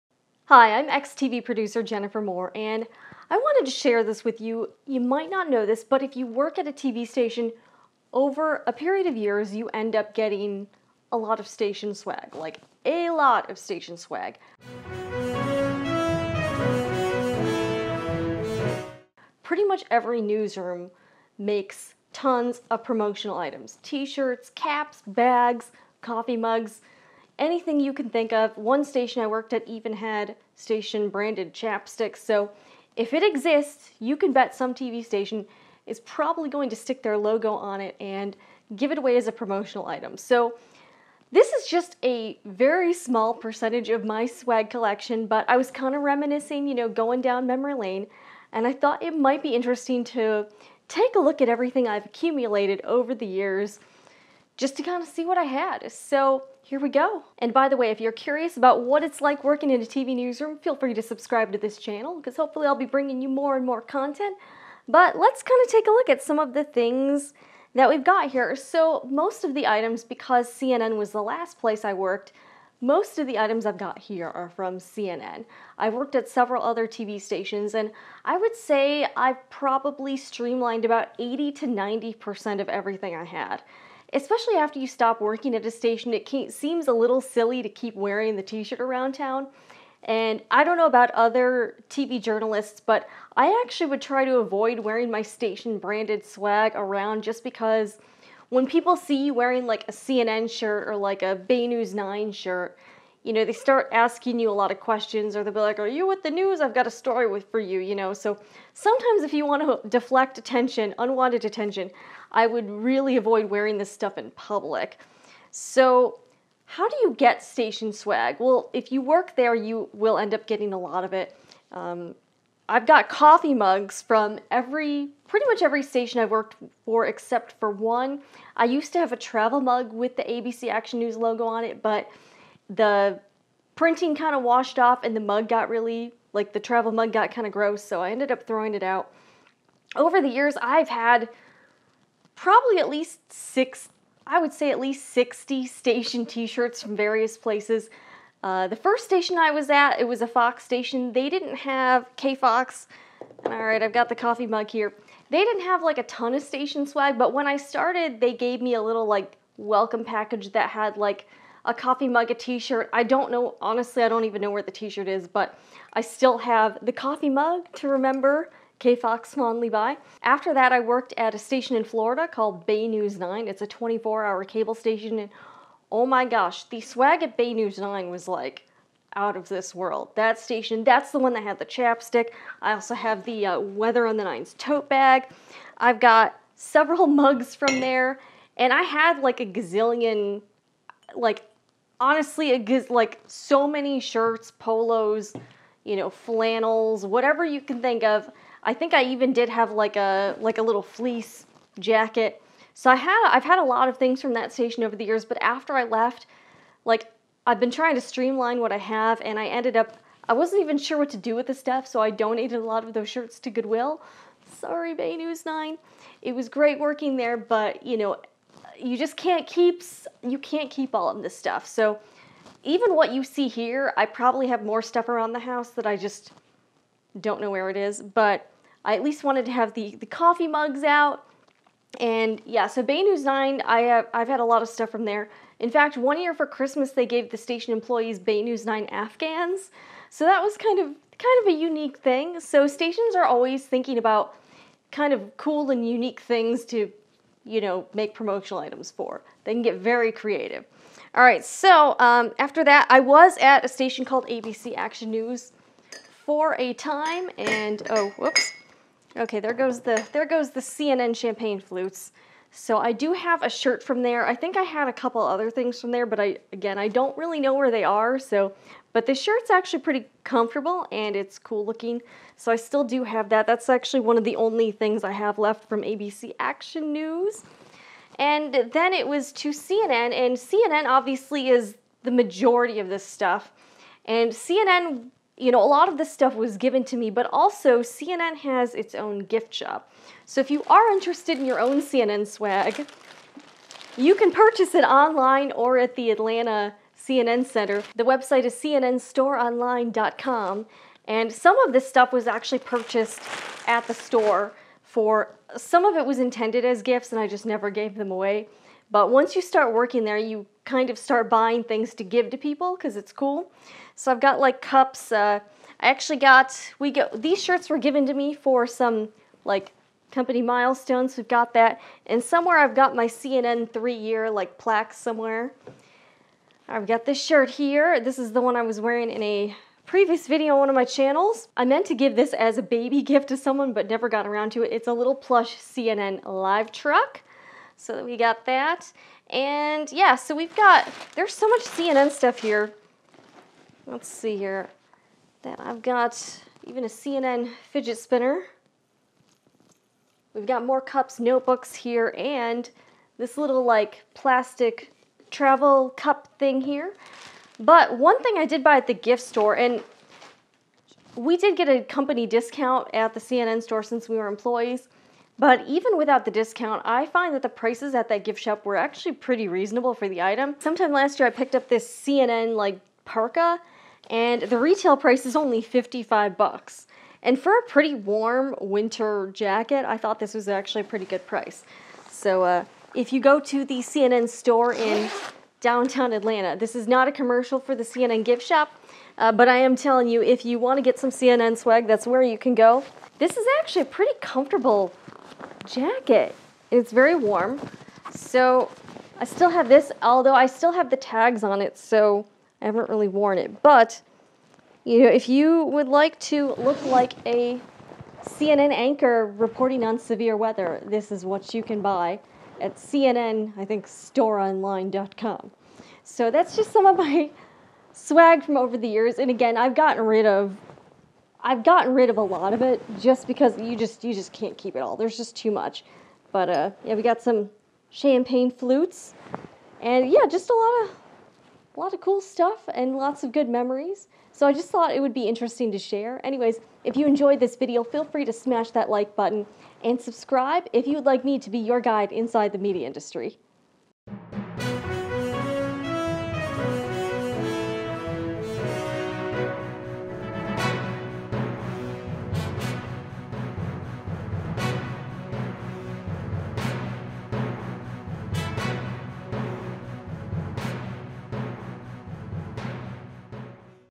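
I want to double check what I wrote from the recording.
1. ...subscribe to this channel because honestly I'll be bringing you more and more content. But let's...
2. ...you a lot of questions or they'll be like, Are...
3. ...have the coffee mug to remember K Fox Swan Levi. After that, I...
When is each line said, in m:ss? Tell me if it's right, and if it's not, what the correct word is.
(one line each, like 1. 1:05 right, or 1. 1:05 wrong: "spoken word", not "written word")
1. 1:01 wrong: "hopefully", not "honestly"
2. 1:44 right
3. 2:46 right.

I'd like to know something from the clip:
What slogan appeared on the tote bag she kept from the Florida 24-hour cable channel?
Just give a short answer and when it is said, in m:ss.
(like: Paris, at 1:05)
Weather on the Nines, at 3:03.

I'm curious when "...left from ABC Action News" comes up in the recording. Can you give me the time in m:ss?
4:35.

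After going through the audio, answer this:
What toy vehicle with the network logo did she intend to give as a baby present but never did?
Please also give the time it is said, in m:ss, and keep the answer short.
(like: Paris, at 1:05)
Plush CNN live truck, at 5:35.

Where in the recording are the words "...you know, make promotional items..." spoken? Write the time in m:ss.
4:07.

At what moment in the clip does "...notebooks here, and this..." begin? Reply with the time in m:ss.
5:51.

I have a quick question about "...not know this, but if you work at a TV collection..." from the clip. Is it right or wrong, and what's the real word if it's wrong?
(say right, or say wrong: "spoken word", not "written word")
wrong: "station", not "collection".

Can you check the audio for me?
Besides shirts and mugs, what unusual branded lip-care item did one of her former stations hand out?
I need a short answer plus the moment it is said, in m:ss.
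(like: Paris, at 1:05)
Chapsticks, at 0:31.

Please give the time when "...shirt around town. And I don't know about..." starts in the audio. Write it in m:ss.
1:28.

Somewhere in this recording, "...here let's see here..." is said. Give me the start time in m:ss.
5:42.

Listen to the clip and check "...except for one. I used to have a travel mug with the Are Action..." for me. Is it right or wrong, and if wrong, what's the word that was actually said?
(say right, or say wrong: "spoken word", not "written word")
wrong: "ABC", not "Are".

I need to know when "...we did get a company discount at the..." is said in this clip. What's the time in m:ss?
6:01.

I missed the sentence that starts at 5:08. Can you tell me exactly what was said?
But once you start working there, you kind of start buying things to give to people because it's cool.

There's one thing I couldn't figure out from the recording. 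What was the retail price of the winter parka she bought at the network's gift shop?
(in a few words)
$55.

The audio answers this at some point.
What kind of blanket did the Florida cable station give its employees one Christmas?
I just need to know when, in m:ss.
3:58.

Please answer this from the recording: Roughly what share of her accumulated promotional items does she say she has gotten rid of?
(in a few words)
80 to 90%.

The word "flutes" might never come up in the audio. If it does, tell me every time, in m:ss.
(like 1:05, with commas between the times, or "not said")
4:21, 7:08.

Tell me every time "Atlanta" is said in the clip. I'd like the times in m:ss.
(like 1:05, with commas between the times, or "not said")
4:56, 6:26.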